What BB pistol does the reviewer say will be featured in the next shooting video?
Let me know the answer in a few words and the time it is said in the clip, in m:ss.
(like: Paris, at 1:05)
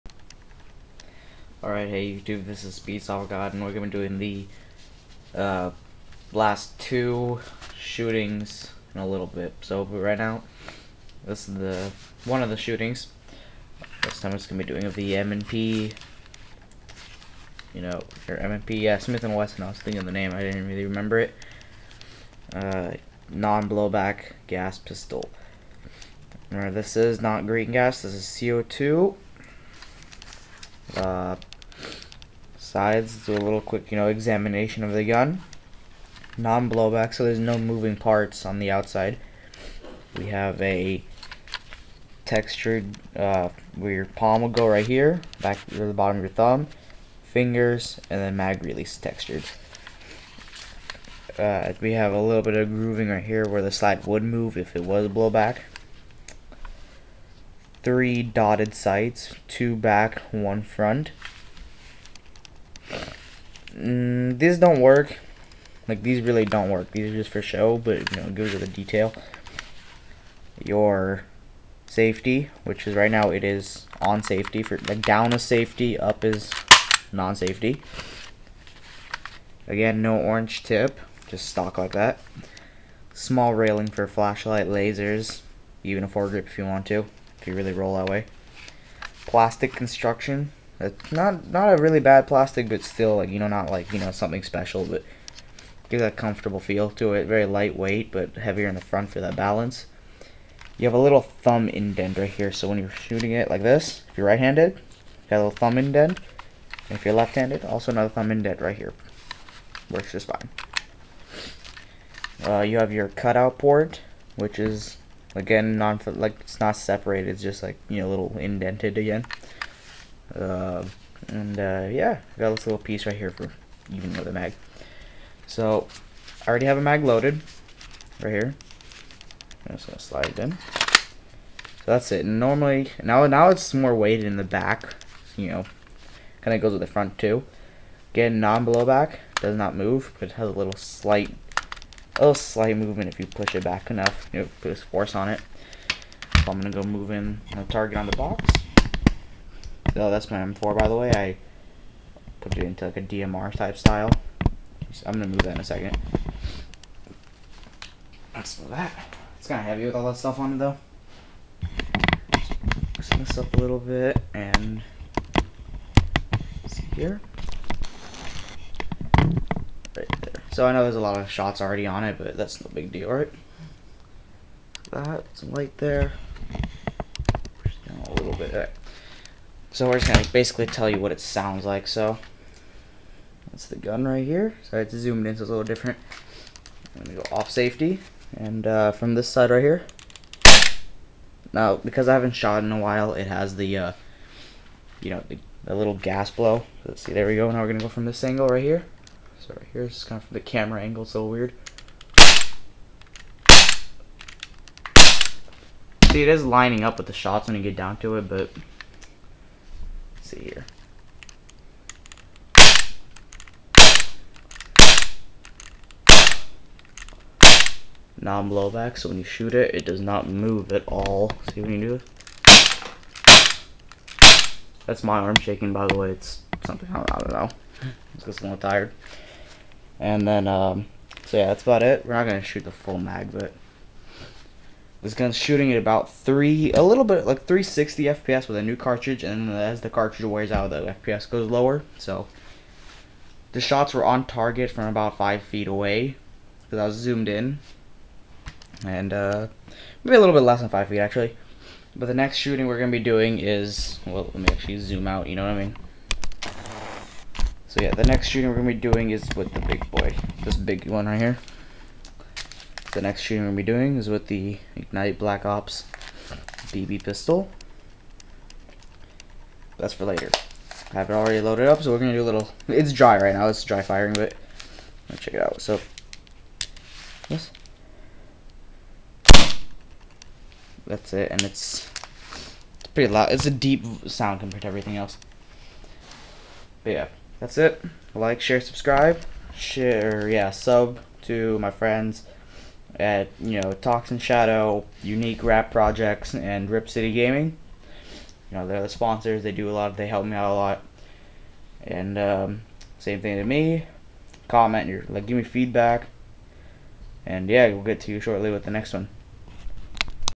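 Ignite Black Ops, at 4:24.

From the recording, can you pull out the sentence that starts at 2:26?
So I'm gonna go move in the target on the box.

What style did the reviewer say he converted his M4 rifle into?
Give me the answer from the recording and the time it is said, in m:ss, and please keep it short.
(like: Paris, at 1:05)
DMR, at 2:33.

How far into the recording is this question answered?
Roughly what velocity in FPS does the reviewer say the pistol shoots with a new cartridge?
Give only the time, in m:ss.
3:57.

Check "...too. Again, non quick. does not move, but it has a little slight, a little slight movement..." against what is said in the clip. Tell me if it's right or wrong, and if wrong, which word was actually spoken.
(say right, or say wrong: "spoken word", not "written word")
wrong: "blowback", not "quick".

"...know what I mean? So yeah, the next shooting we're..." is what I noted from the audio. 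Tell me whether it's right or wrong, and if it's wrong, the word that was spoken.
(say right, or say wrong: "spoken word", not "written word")
right.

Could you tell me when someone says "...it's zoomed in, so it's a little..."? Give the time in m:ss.
3:04.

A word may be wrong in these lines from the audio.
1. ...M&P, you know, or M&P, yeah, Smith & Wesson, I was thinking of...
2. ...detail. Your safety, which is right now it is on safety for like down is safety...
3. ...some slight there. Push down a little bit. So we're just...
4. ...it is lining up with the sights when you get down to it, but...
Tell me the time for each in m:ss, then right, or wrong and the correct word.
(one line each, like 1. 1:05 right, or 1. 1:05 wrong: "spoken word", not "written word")
1. 0:15 right
2. 1:08 right
3. 2:55 wrong: "light", not "slight"
4. 3:26 wrong: "shots", not "sights".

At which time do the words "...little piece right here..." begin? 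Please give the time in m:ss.
2:02.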